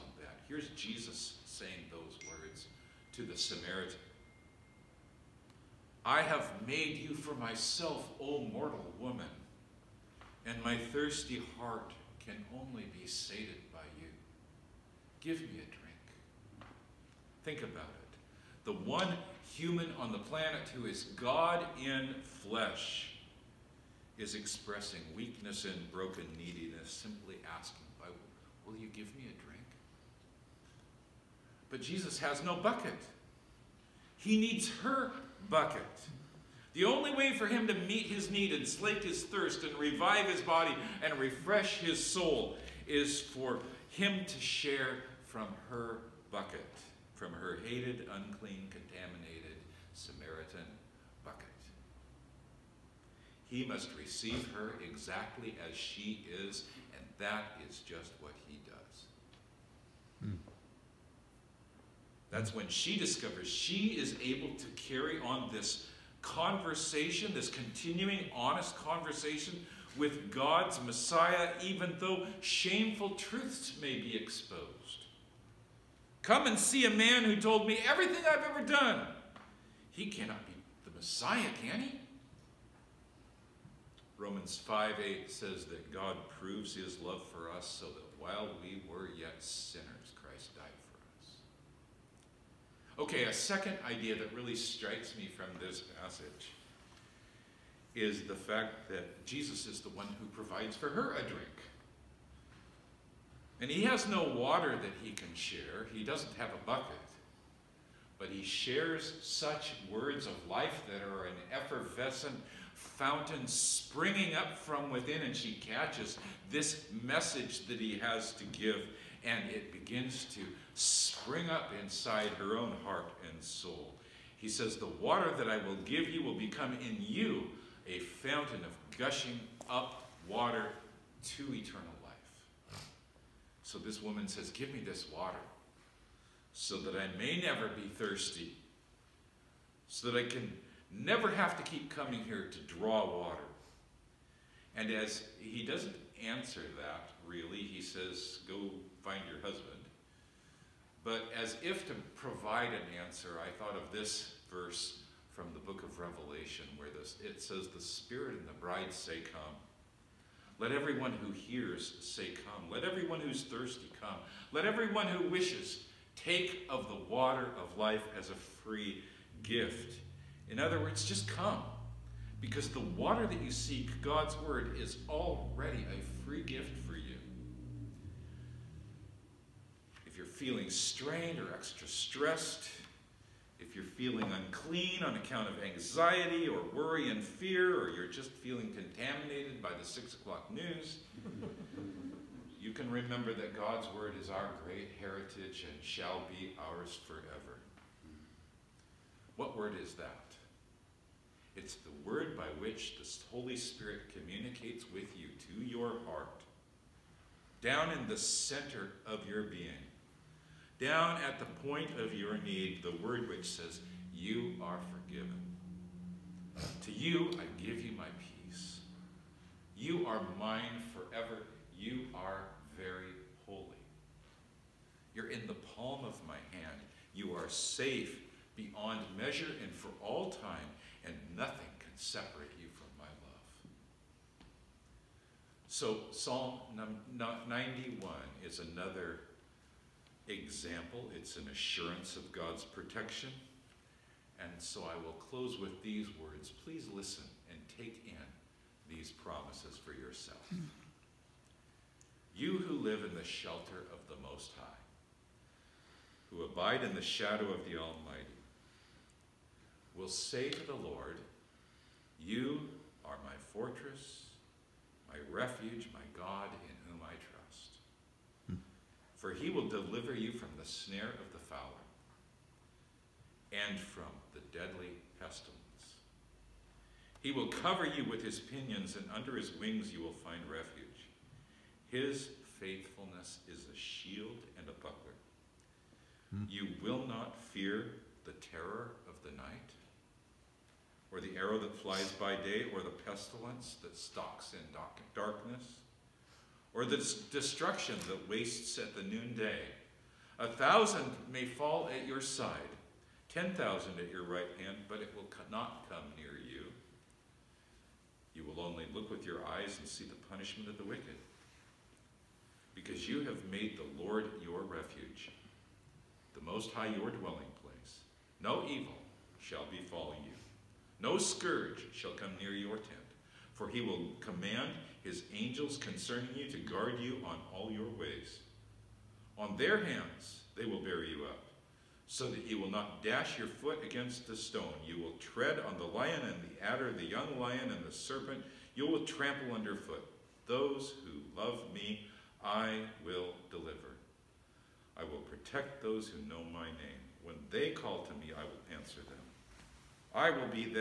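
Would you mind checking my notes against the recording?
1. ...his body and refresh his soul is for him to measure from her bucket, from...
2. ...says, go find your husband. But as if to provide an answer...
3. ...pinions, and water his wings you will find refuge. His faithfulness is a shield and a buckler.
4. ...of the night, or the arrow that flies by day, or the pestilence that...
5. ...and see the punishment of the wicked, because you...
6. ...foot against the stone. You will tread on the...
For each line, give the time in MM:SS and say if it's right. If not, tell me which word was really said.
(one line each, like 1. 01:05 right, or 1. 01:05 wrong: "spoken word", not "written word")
1. 00:40 wrong: "share", not "measure"
2. 02:27 right
3. 04:38 wrong: "under", not "water"
4. 04:49 right
5. 05:09 right
6. 05:33 right.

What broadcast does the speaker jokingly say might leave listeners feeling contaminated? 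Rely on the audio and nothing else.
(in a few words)
The six o'clock news.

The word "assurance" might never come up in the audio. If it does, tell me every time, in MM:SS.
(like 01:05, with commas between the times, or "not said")
04:01.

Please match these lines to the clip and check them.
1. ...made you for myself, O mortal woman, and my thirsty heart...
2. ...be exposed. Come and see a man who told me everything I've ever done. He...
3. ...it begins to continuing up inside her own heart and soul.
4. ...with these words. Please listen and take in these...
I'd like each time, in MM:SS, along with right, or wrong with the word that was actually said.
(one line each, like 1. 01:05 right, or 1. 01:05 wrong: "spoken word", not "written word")
1. 00:06 right
2. 01:13 right
3. 01:59 wrong: "spring", not "continuing"
4. 04:05 right.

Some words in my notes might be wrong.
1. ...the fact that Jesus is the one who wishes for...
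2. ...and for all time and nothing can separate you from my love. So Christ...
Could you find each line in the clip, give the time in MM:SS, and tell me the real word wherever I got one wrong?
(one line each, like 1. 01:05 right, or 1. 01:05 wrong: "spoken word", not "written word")
1. 01:38 wrong: "provides", not "wishes"
2. 03:49 wrong: "Psalm", not "Christ".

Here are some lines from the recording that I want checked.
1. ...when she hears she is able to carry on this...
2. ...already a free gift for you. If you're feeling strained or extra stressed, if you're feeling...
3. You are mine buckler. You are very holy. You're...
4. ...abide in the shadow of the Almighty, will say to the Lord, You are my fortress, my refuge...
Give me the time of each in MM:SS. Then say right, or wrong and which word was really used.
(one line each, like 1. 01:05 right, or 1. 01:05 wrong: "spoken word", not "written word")
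1. 01:02 wrong: "discovers", not "hears"
2. 02:55 right
3. 03:39 wrong: "forever", not "buckler"
4. 04:16 right.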